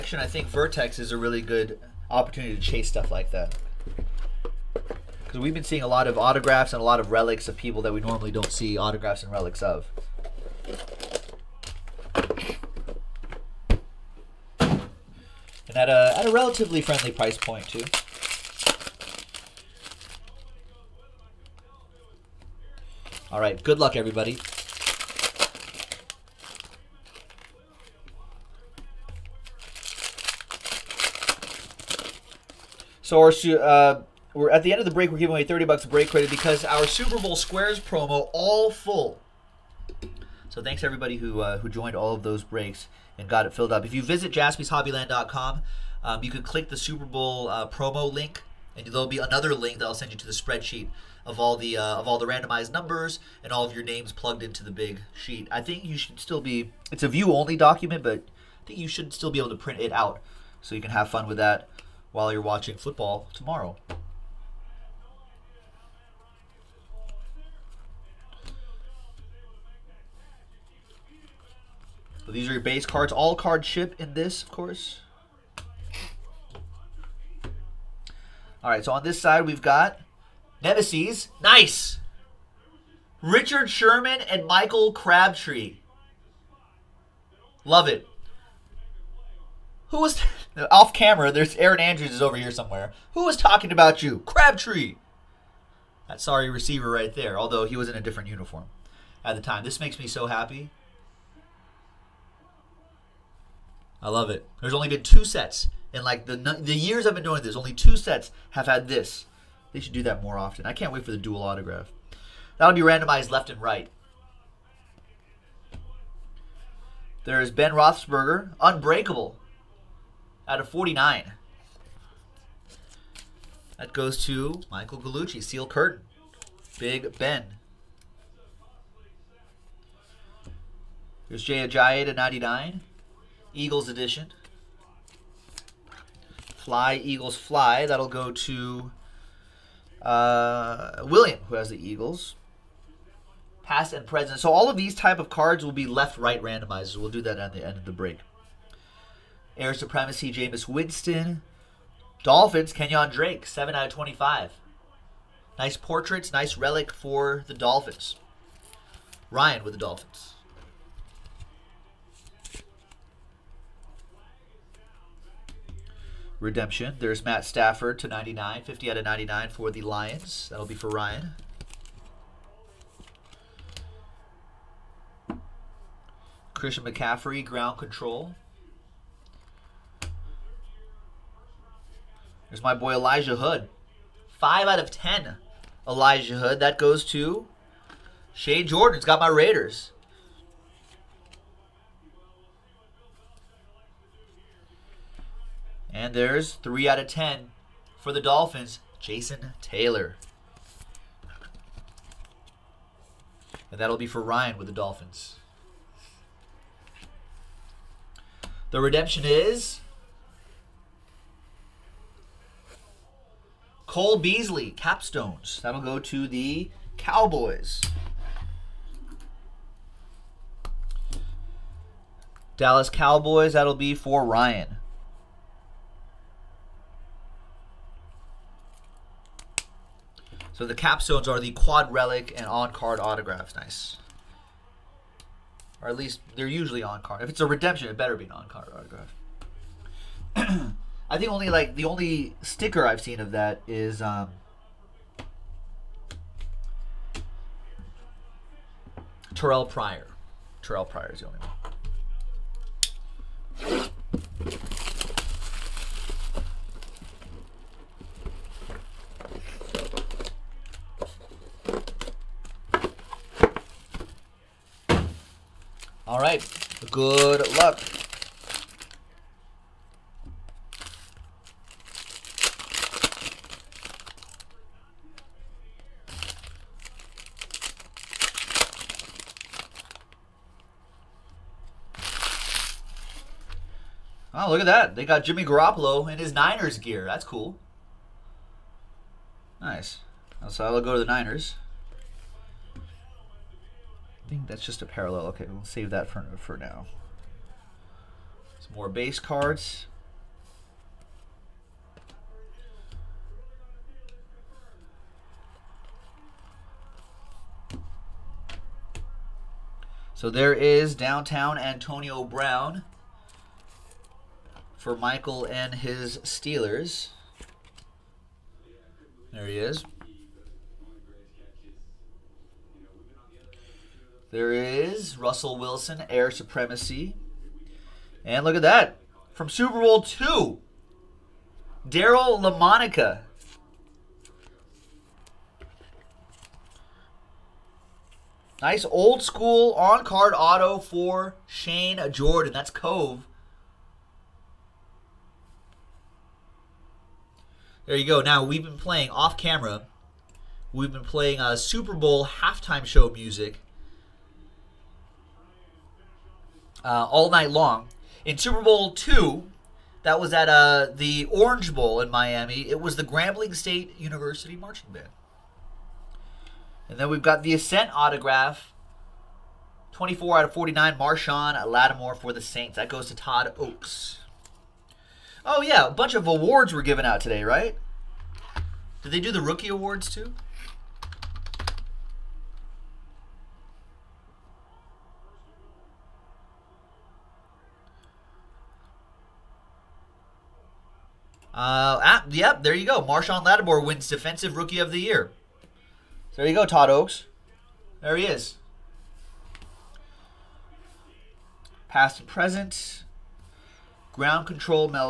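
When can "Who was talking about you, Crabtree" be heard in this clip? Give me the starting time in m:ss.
1:33.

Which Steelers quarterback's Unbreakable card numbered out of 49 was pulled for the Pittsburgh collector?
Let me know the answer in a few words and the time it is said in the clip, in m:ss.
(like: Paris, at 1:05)
Ben Roethlisberger, at 1:57.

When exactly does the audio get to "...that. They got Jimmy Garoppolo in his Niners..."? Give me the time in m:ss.
4:44.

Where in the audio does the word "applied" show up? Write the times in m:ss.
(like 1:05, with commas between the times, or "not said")
not said.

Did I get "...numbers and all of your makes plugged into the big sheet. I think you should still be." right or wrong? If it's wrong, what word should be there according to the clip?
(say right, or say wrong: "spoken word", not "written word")
wrong: "names", not "makes".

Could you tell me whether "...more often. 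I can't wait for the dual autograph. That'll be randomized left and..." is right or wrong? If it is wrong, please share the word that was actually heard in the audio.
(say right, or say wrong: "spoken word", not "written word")
right.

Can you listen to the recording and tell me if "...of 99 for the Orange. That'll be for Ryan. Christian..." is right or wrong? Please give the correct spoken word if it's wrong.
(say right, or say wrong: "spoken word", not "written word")
wrong: "Lions", not "Orange".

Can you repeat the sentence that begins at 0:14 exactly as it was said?
And at a, at a relatively friendly price point, too.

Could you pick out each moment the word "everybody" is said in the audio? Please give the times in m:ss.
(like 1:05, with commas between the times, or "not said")
0:23, 0:40.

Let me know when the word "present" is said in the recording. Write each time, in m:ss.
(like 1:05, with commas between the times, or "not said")
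2:24, 6:42.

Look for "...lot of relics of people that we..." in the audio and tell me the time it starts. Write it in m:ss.
0:06.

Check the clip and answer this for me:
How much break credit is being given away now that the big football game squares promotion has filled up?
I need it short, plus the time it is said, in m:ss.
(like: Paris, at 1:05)
30 bucks, at 0:35.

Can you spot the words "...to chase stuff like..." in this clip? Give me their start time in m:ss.
0:02.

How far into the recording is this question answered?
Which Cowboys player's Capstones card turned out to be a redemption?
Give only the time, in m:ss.
3:33.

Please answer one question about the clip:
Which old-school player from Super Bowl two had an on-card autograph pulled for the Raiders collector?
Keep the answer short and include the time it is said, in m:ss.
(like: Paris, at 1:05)
Daryle Lamonica, at 5:31.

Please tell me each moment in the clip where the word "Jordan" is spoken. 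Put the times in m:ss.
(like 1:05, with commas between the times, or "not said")
3:08, 5:42.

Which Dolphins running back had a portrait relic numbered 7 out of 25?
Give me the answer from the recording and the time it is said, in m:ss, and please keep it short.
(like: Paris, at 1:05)
Kenyan Drake, at 2:32.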